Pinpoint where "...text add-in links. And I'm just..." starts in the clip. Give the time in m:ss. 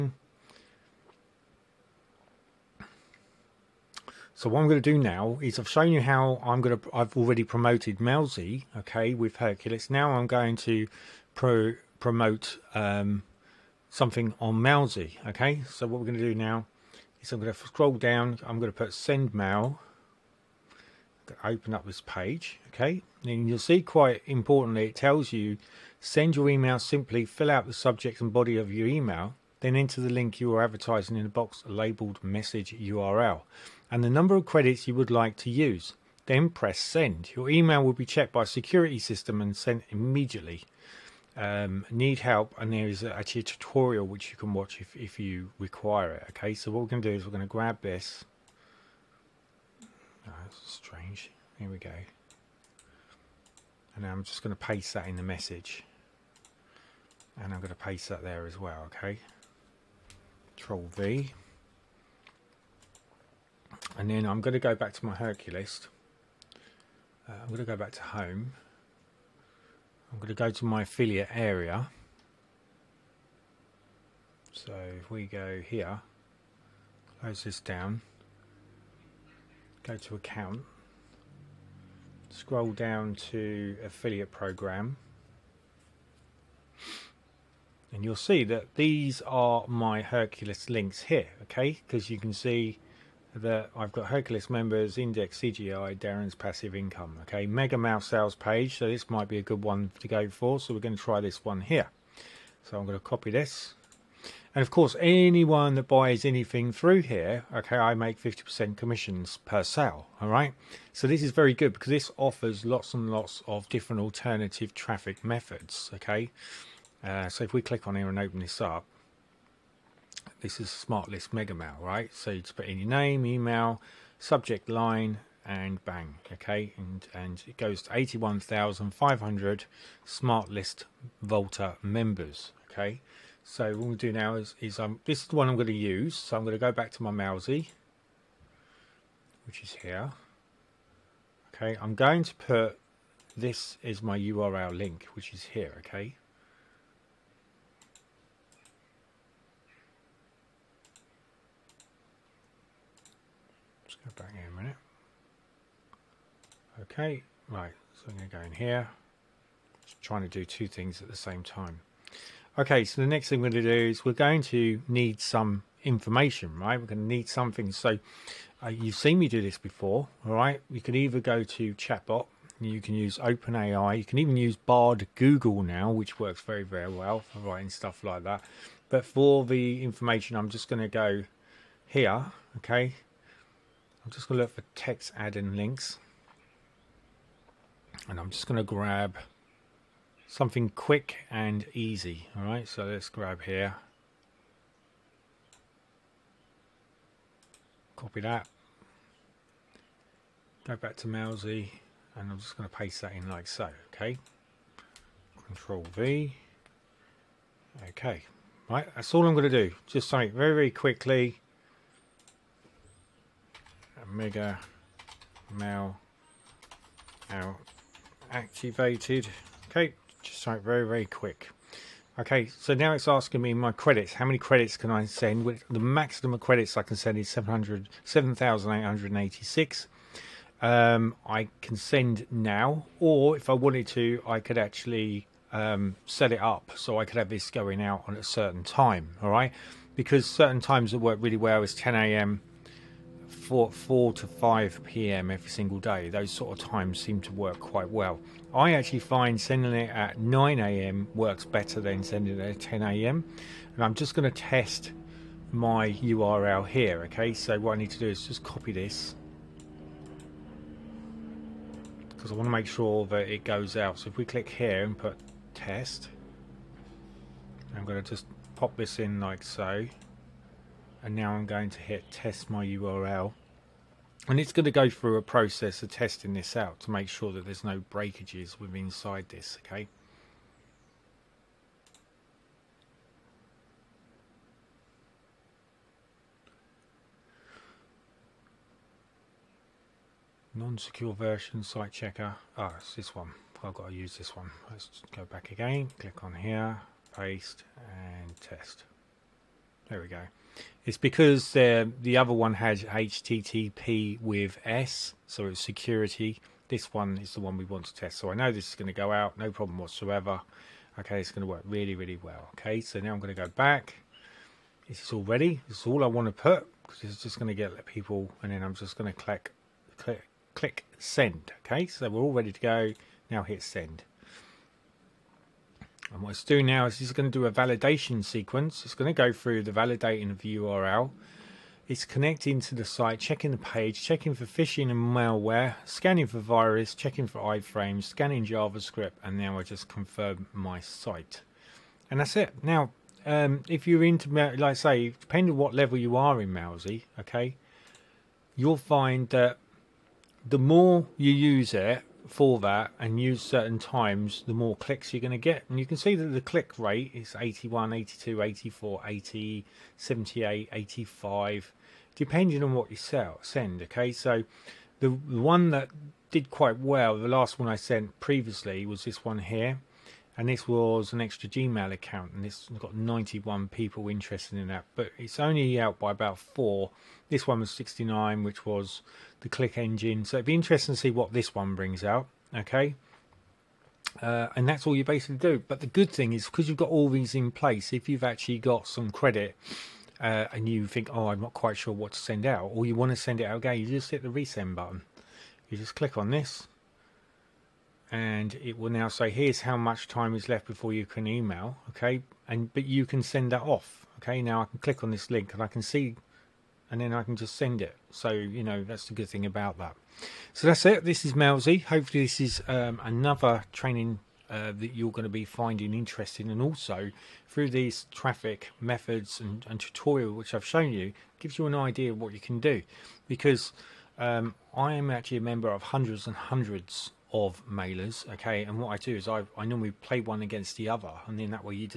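3:04.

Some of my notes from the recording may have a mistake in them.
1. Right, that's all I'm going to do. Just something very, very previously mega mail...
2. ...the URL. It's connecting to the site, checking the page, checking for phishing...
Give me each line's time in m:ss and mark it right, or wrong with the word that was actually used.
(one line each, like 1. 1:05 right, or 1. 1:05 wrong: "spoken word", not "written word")
1. 3:28 wrong: "quickly", not "previously"
2. 5:30 right.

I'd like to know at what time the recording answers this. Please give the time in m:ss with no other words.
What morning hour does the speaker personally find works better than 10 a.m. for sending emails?
4:10.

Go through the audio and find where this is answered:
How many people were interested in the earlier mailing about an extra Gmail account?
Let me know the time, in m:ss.
6:12.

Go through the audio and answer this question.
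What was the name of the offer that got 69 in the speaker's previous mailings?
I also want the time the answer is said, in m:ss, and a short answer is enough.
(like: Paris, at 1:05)
Click Engine, at 6:19.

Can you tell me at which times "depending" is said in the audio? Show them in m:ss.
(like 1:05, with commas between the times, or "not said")
5:45, 6:02.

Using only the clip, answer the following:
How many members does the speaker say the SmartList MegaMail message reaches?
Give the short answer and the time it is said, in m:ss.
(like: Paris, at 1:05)
81,500, at 2:07.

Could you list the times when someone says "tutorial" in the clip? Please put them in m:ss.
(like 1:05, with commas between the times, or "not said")
0:43, 6:59.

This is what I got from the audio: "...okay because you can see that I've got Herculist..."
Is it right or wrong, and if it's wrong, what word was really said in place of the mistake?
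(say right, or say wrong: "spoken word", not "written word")
right.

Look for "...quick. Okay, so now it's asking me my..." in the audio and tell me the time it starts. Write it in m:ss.
3:41.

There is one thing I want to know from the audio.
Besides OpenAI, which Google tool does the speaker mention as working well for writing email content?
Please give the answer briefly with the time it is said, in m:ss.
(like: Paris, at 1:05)
Bard, at 2:54.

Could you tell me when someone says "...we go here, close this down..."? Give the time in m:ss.
1:15.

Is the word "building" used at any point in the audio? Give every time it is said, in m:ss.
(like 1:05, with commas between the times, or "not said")
not said.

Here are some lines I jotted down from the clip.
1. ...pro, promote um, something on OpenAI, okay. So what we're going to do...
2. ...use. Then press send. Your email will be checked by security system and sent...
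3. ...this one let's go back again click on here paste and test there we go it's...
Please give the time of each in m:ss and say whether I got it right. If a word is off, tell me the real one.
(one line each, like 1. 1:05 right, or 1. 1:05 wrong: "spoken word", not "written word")
1. 0:11 wrong: "Mailsy", not "OpenAI"
2. 0:35 right
3. 4:54 right.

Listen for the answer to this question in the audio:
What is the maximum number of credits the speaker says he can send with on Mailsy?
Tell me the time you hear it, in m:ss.
3:47.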